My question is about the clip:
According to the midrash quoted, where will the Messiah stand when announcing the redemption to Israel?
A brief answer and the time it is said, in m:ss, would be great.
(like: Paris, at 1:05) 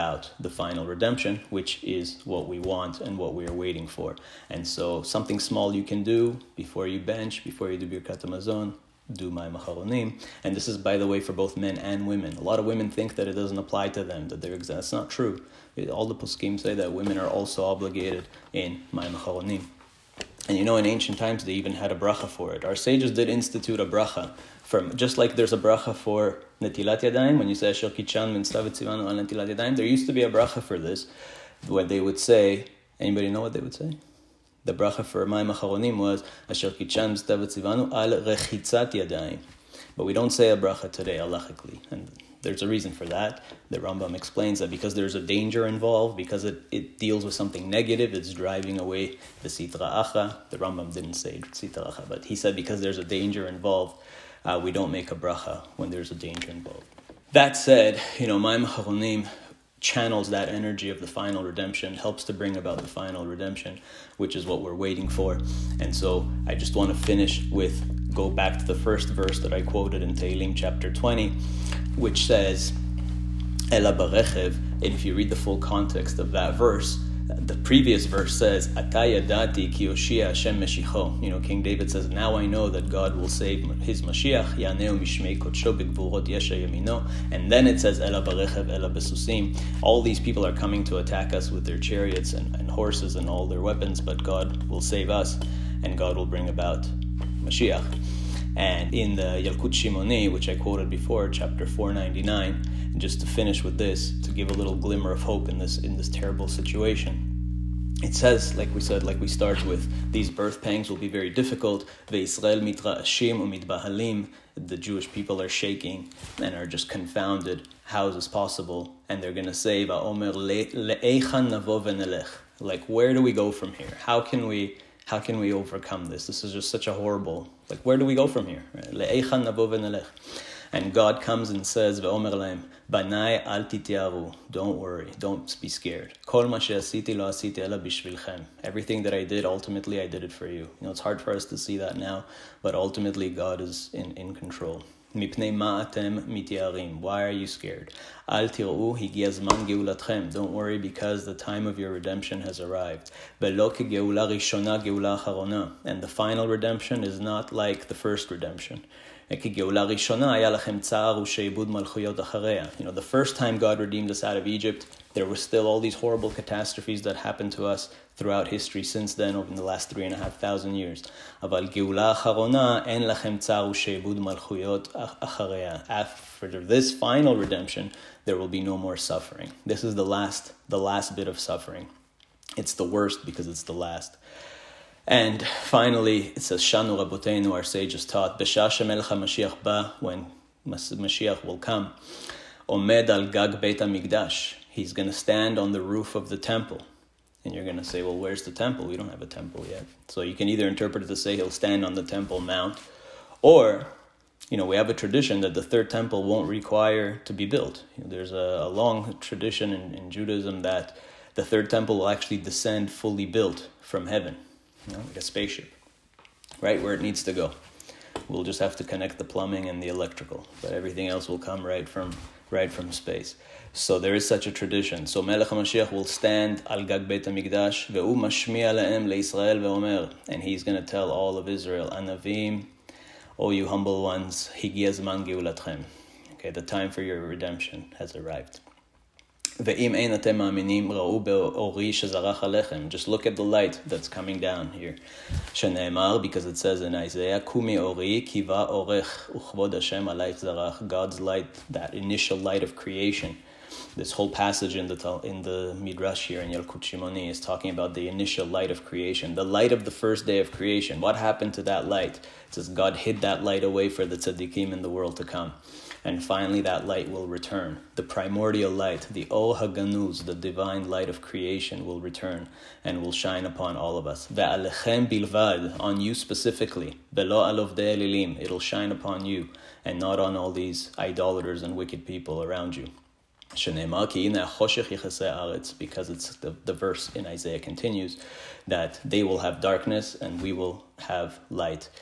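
the roof of the temple, at 3:15.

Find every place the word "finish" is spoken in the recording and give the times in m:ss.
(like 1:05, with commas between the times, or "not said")
1:06, 1:43.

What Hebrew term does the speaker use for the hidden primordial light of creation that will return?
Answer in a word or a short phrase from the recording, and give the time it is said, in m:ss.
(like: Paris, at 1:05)
Or Haganuz, at 4:29.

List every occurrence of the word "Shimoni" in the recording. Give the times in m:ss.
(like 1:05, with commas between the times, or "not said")
1:39, 4:16.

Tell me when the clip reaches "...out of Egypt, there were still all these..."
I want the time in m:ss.
2:44.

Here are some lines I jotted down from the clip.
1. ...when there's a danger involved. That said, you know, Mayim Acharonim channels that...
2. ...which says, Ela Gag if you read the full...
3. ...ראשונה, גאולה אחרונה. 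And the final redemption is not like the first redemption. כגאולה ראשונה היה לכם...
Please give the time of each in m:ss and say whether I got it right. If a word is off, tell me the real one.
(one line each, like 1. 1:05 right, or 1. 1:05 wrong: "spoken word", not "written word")
1. 0:55 right
2. 1:11 wrong: "And", not "Gag"
3. 2:34 right.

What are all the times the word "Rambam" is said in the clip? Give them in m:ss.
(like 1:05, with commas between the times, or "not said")
0:43, 0:50.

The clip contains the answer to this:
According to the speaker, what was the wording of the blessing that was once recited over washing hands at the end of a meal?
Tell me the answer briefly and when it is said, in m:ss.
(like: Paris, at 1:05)
Asher Kichan Tzivanu al Rechitzat Yadayim, at 0:36.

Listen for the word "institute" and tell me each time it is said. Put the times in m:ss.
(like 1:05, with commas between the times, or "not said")
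0:23.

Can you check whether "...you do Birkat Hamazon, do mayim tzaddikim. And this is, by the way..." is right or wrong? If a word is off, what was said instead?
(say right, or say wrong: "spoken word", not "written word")
wrong: "acharonim", not "tzaddikim".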